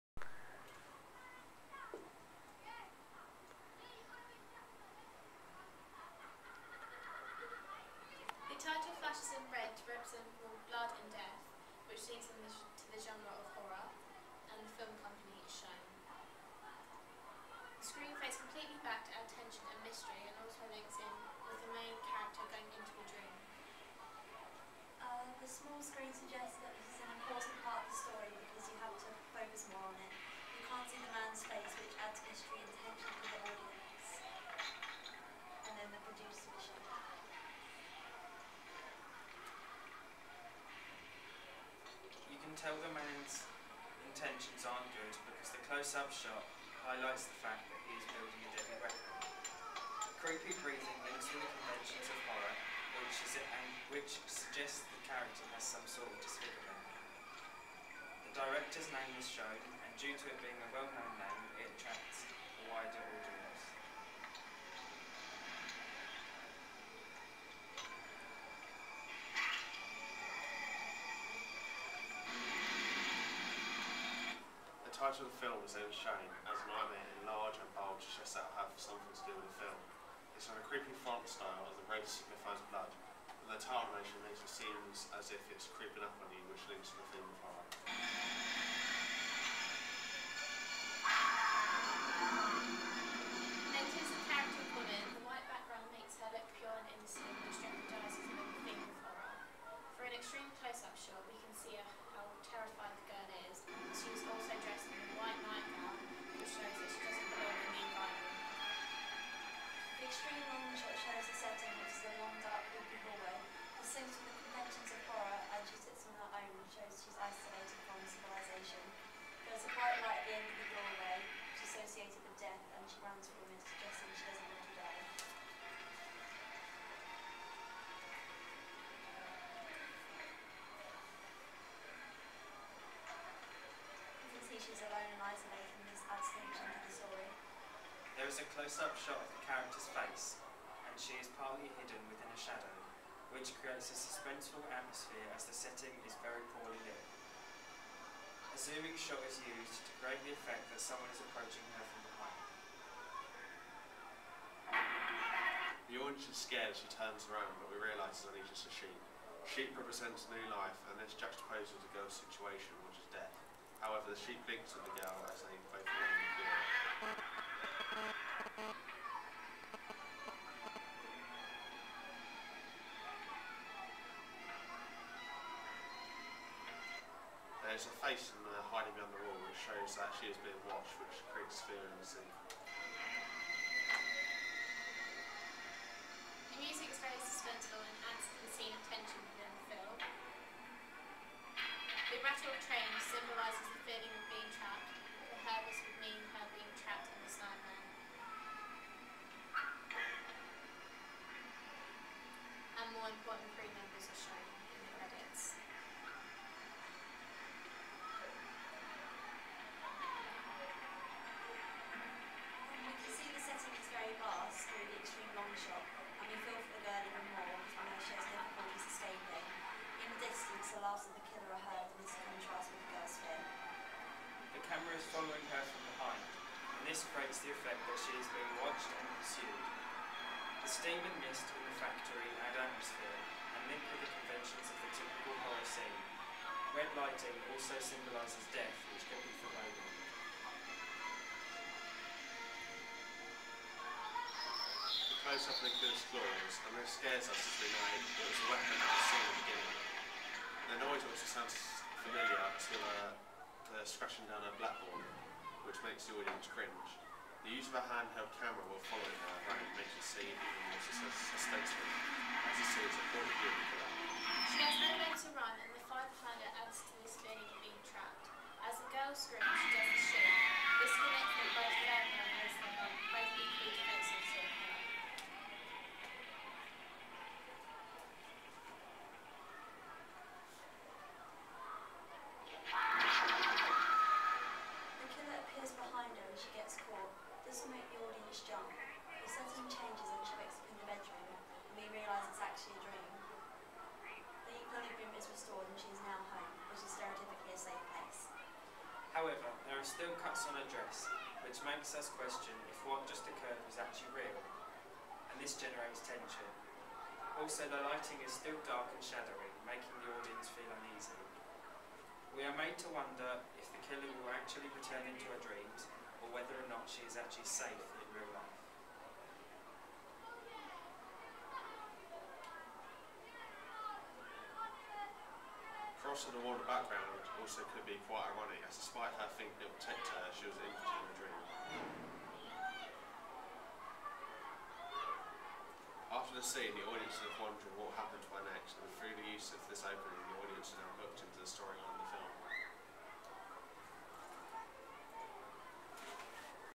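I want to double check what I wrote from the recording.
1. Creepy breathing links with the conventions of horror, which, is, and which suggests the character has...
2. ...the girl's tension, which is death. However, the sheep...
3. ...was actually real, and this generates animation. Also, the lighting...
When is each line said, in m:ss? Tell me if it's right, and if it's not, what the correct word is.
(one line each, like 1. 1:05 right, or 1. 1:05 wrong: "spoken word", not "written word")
1. 0:50 right
2. 2:41 wrong: "situation", not "tension"
3. 5:03 wrong: "tension", not "animation".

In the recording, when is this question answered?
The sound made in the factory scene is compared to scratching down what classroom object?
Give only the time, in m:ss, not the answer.
4:14.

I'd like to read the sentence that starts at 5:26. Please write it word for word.
across the water background also could be quite ironic, as despite her thinking it would protect her, she was in a dream.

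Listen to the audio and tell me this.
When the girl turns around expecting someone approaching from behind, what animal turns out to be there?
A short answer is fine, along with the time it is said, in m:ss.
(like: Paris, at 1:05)
A sheep, at 2:38.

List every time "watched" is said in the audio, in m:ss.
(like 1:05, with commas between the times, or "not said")
3:00, 3:48.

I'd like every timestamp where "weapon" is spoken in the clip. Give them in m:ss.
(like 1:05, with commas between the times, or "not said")
0:48, 4:08.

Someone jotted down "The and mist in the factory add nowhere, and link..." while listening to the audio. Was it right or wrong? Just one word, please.
wrong.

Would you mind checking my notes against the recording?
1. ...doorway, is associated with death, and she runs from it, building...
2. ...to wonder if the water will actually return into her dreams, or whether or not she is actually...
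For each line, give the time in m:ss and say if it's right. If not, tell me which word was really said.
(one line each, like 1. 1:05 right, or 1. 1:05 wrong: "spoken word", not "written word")
1. 2:00 wrong: "suggesting", not "building"
2. 5:12 wrong: "killer", not "water".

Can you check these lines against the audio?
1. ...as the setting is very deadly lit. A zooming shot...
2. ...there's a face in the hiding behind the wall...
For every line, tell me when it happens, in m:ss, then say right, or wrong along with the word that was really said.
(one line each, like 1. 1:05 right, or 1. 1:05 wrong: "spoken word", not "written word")
1. 2:25 wrong: "poorly", not "deadly"
2. 2:57 right.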